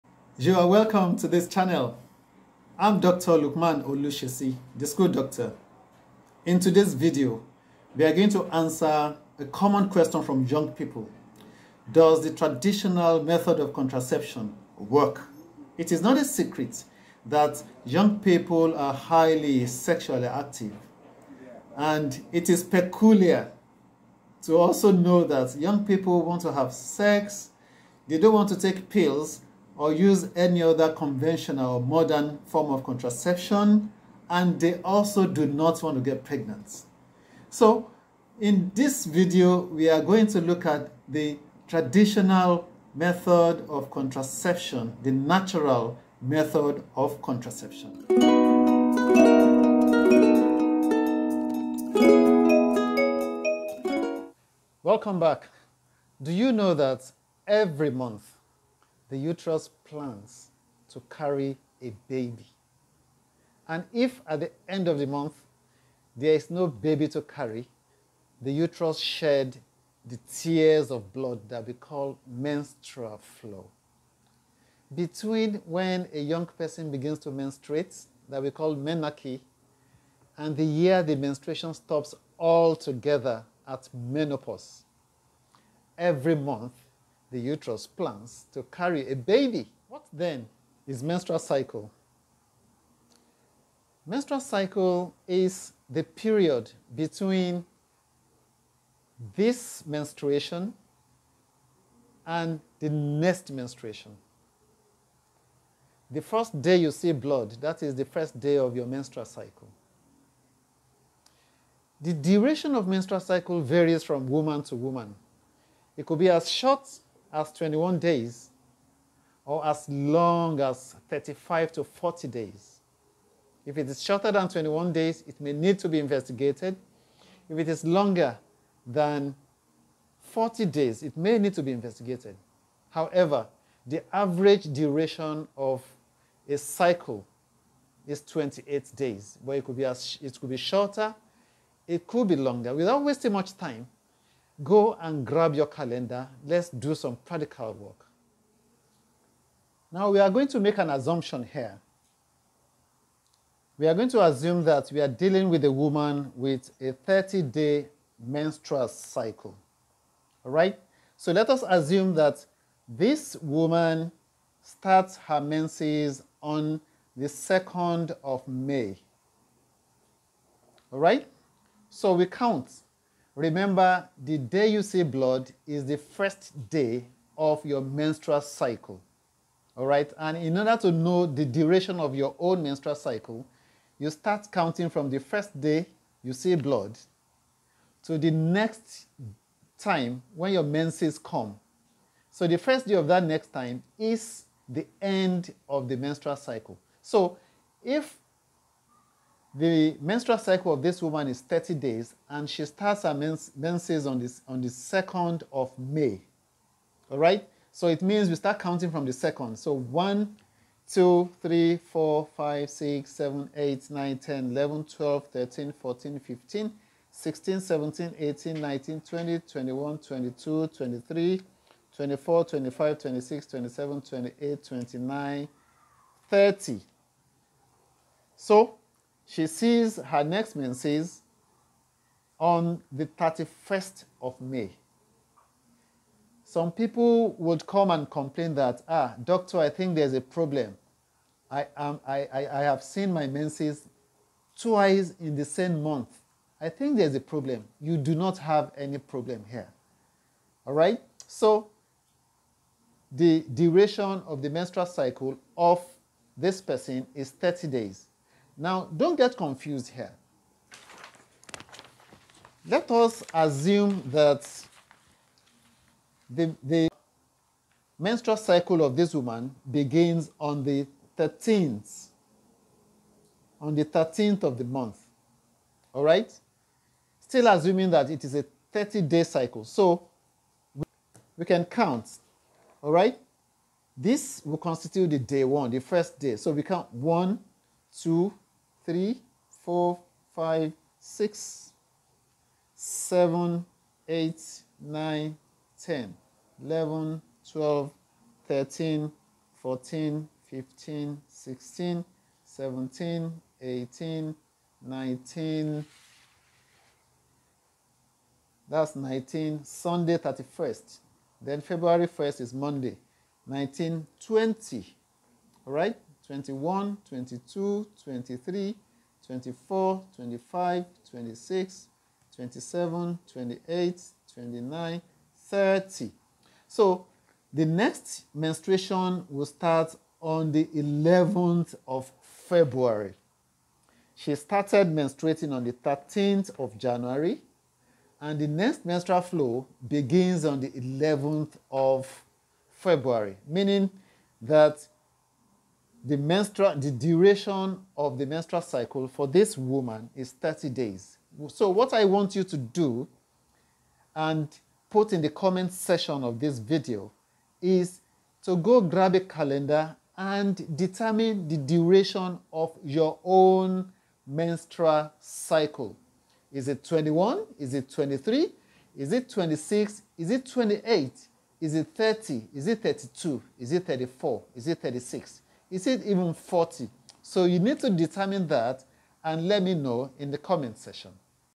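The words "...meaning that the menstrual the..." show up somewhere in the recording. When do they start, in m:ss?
5:43.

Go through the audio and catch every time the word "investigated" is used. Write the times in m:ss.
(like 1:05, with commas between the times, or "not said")
2:05, 2:11.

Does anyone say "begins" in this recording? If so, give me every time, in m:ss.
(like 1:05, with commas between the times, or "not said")
1:16, 4:29, 5:39.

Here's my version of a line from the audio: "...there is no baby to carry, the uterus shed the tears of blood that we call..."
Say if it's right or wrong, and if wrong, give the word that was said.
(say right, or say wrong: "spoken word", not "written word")
right.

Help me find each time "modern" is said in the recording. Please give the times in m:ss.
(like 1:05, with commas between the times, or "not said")
0:31.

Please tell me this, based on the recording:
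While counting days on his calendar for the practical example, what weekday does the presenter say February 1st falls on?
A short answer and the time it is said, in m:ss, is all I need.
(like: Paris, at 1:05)
Monday, at 5:12.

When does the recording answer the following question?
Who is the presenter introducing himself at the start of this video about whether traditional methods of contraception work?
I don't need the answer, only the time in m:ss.
0:02.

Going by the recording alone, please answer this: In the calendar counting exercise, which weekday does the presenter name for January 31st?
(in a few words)
Sunday.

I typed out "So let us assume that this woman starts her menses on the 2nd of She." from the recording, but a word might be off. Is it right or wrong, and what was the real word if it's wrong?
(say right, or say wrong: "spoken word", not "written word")
wrong: "May", not "She".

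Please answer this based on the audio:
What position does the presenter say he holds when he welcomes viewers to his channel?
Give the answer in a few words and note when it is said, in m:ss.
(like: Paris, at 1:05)
School doctor, at 0:04.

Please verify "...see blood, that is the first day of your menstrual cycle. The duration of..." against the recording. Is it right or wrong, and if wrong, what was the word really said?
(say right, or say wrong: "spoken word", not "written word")
right.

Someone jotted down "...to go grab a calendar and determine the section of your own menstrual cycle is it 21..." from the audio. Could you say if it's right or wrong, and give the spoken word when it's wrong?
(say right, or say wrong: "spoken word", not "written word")
wrong: "duration", not "section".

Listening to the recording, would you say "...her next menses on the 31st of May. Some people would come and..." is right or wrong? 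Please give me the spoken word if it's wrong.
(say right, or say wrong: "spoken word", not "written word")
right.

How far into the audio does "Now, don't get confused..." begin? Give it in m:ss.
4:18.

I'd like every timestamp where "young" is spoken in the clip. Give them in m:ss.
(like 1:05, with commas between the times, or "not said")
0:10, 0:17, 0:25, 1:16.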